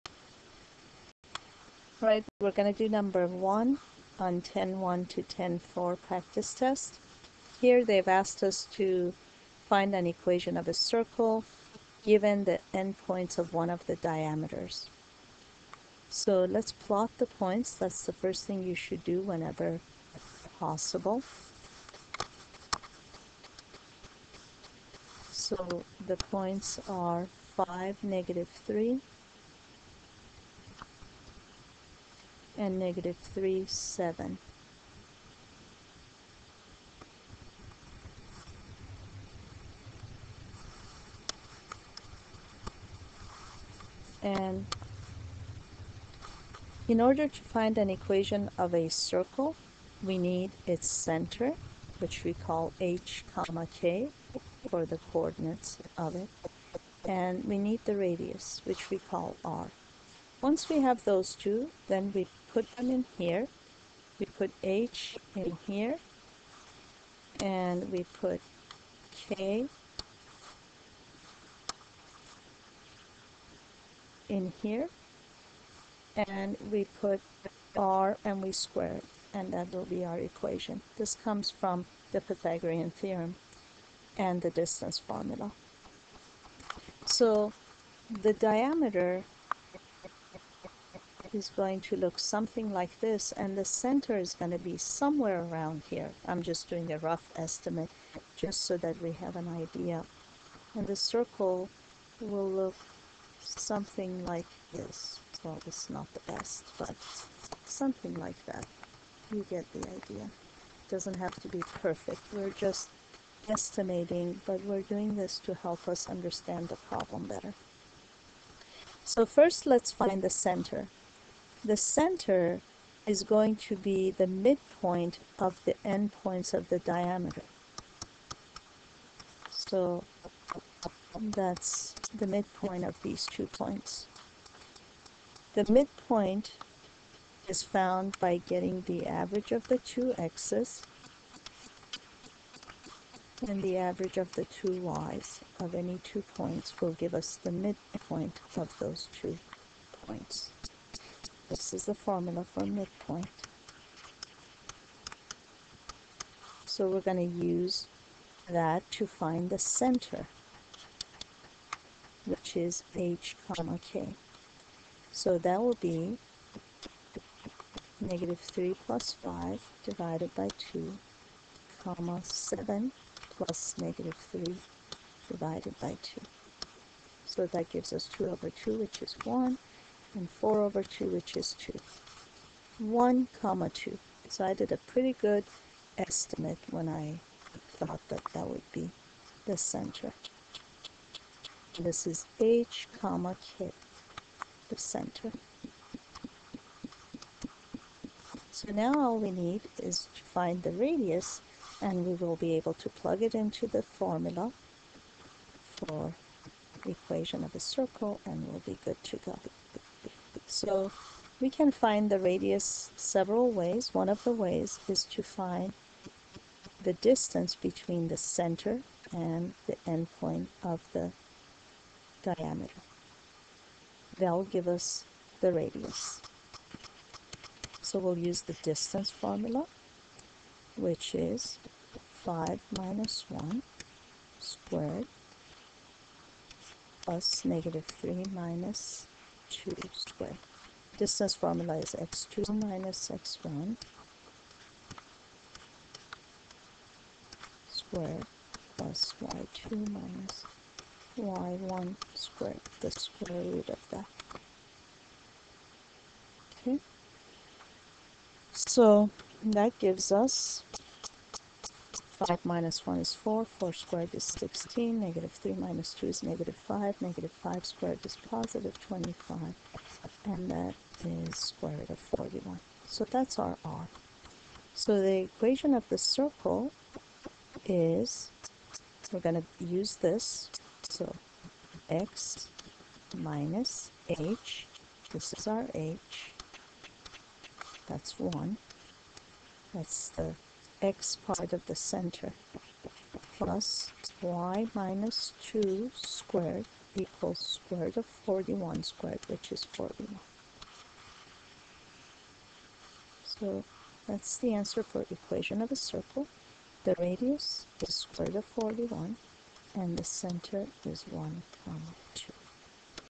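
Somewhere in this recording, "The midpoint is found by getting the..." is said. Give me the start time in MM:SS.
02:15.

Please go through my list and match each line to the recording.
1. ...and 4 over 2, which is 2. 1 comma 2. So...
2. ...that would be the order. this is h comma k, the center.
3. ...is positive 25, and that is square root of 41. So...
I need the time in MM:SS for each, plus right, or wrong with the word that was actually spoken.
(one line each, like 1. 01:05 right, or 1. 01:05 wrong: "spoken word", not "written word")
1. 03:00 right
2. 03:08 wrong: "center", not "order"
3. 04:28 right.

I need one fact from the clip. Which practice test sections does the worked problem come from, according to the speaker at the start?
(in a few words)
10.1 to 10.4.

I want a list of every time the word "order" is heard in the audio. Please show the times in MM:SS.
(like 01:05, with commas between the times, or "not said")
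00:47.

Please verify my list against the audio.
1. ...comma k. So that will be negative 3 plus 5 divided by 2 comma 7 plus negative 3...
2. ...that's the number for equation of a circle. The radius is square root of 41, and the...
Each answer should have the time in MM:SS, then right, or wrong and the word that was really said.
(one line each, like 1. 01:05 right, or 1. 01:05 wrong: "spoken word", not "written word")
1. 02:43 right
2. 05:04 wrong: "answer", not "number".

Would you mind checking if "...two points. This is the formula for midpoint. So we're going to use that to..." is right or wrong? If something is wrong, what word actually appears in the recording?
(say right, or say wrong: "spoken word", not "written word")
right.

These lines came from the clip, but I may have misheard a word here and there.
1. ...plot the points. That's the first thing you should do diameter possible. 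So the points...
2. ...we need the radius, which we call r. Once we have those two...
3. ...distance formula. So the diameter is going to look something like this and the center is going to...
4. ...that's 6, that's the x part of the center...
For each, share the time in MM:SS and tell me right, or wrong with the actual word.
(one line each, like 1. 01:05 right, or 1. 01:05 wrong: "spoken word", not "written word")
1. 00:16 wrong: "whenever", not "diameter"
2. 00:57 right
3. 01:24 right
4. 04:47 wrong: "1", not "6".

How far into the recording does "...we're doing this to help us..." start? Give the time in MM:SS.
01:54.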